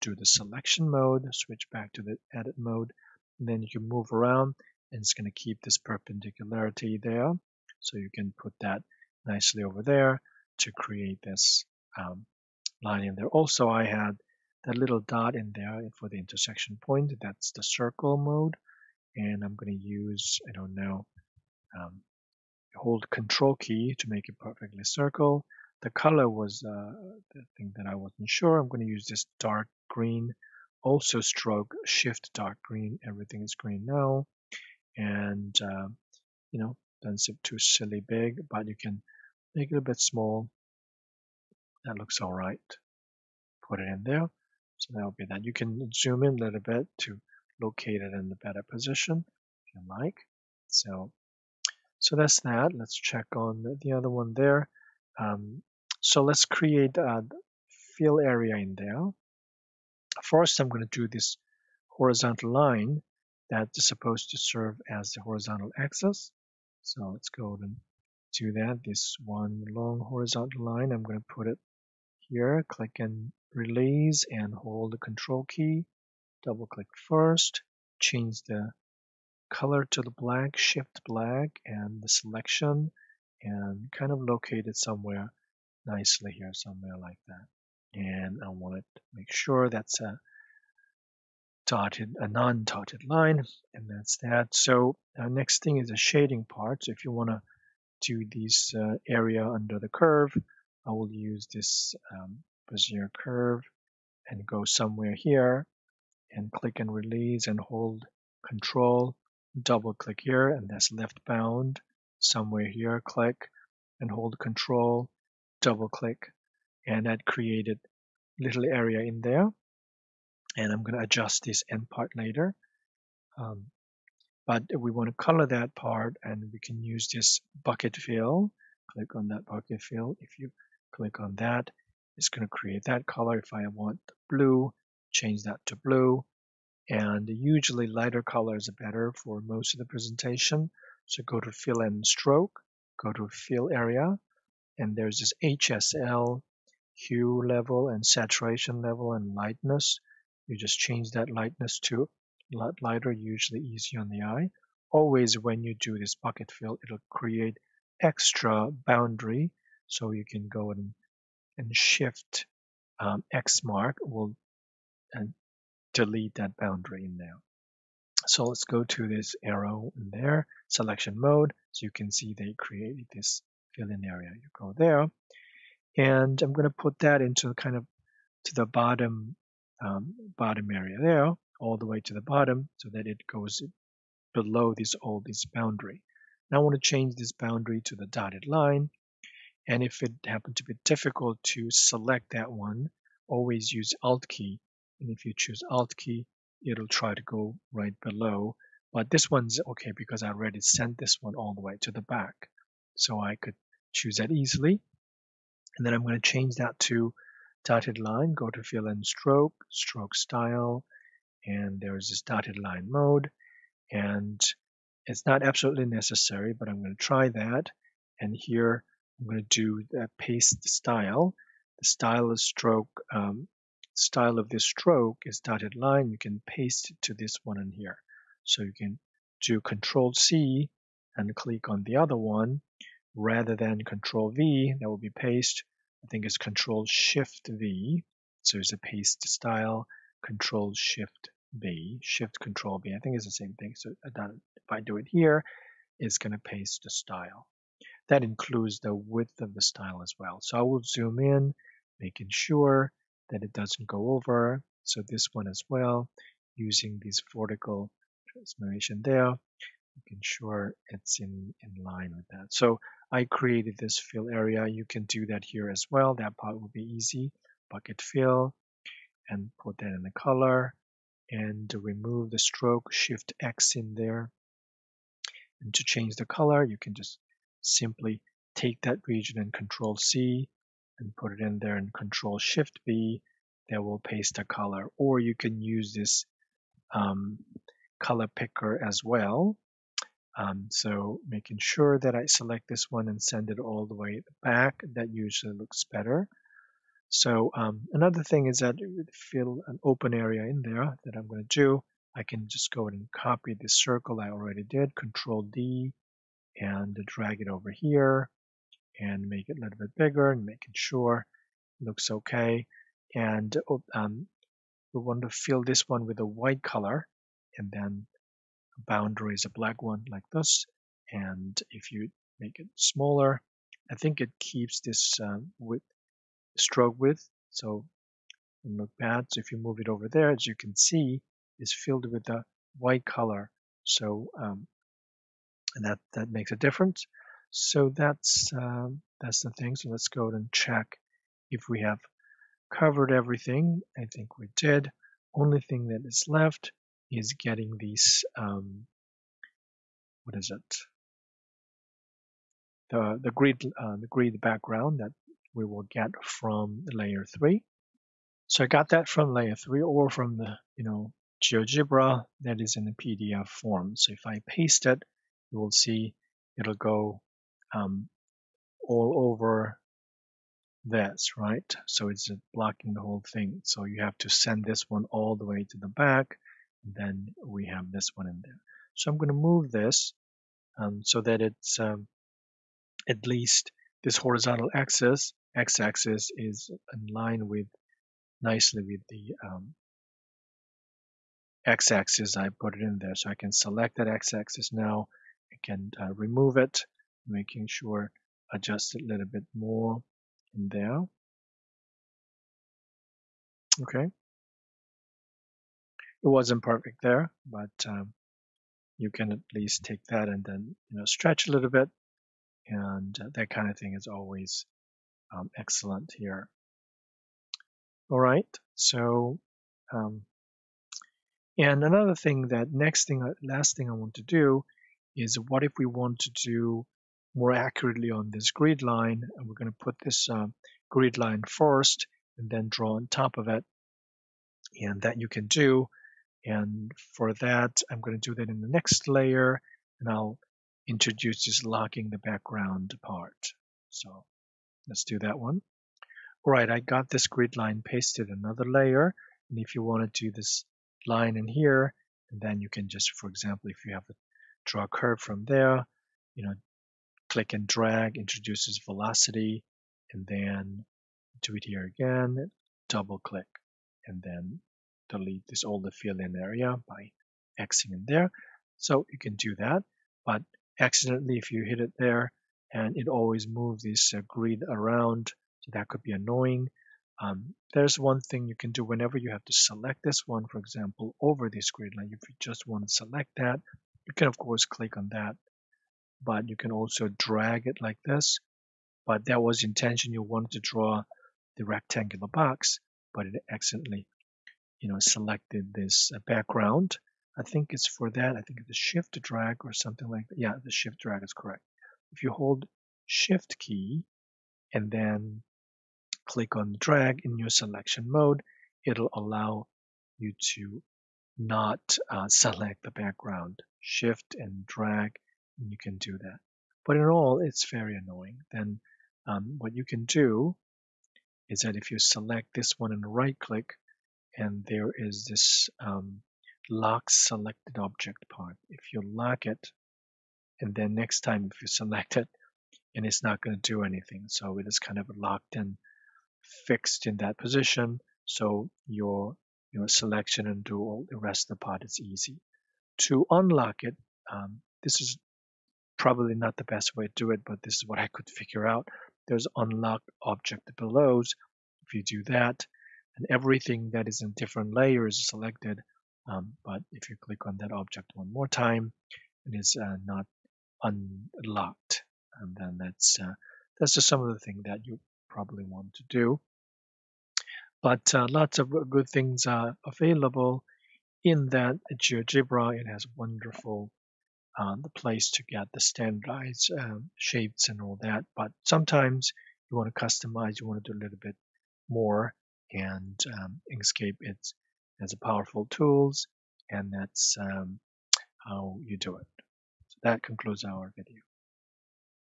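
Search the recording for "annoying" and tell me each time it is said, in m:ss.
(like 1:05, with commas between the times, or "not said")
7:56, 8:37.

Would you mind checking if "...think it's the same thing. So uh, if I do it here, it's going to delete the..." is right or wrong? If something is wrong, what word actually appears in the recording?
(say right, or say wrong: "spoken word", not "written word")
wrong: "paste", not "delete".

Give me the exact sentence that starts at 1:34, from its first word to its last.
So our uh, next thing is the shading part.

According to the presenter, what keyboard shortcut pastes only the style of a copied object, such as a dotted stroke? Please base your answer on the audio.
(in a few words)
Control Shift V.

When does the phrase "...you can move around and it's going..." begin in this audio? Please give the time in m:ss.
0:03.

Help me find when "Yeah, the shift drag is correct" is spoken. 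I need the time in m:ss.
8:20.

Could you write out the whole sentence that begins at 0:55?
Um, so let's create a fill area in there.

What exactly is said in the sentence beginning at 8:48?
If you lock it, and then next time if you select it, and it's not going to do anything.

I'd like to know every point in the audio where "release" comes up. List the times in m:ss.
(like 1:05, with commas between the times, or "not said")
1:13, 1:46.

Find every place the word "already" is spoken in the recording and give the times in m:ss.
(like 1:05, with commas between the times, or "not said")
3:20, 5:04.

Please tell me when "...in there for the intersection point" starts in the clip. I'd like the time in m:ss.
0:15.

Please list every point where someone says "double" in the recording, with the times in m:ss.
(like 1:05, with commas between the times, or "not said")
1:16, 1:49, 1:55, 7:42.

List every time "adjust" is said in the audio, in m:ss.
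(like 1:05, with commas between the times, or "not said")
2:01, 6:38.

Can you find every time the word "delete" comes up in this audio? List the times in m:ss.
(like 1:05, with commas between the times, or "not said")
2:45, 7:45.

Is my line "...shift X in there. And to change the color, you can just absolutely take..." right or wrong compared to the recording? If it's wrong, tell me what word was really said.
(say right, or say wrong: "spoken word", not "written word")
wrong: "simply", not "absolutely".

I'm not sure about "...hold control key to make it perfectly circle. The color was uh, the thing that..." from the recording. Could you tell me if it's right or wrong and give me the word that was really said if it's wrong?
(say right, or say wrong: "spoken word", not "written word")
right.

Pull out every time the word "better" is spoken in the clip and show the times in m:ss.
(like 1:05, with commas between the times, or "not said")
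0:48, 2:18, 4:55.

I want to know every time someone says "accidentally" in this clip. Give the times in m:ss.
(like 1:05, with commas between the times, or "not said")
7:50, 8:13.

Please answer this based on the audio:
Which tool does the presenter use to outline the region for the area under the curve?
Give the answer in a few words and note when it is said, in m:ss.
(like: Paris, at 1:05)
Bezier curve, at 1:42.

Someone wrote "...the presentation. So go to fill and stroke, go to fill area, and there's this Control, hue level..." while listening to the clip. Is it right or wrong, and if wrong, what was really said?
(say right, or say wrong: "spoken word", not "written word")
wrong: "HSL", not "Control".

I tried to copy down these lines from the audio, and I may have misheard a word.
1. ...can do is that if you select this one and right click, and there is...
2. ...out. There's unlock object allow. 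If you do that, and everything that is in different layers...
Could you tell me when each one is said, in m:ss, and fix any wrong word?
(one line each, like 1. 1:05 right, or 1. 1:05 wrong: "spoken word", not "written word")
1. 8:39 right
2. 9:08 wrong: "below", not "allow".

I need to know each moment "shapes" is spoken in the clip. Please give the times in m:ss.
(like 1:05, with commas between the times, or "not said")
9:37.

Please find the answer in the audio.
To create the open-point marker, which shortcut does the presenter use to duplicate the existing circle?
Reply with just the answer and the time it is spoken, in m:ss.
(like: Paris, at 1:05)
Control D, at 5:04.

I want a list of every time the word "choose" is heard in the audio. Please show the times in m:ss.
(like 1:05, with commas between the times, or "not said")
3:15, 3:23.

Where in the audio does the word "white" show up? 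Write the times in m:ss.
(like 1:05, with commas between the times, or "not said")
5:16, 5:32.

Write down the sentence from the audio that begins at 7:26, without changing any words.
All right, I got this grid line pasted another layer.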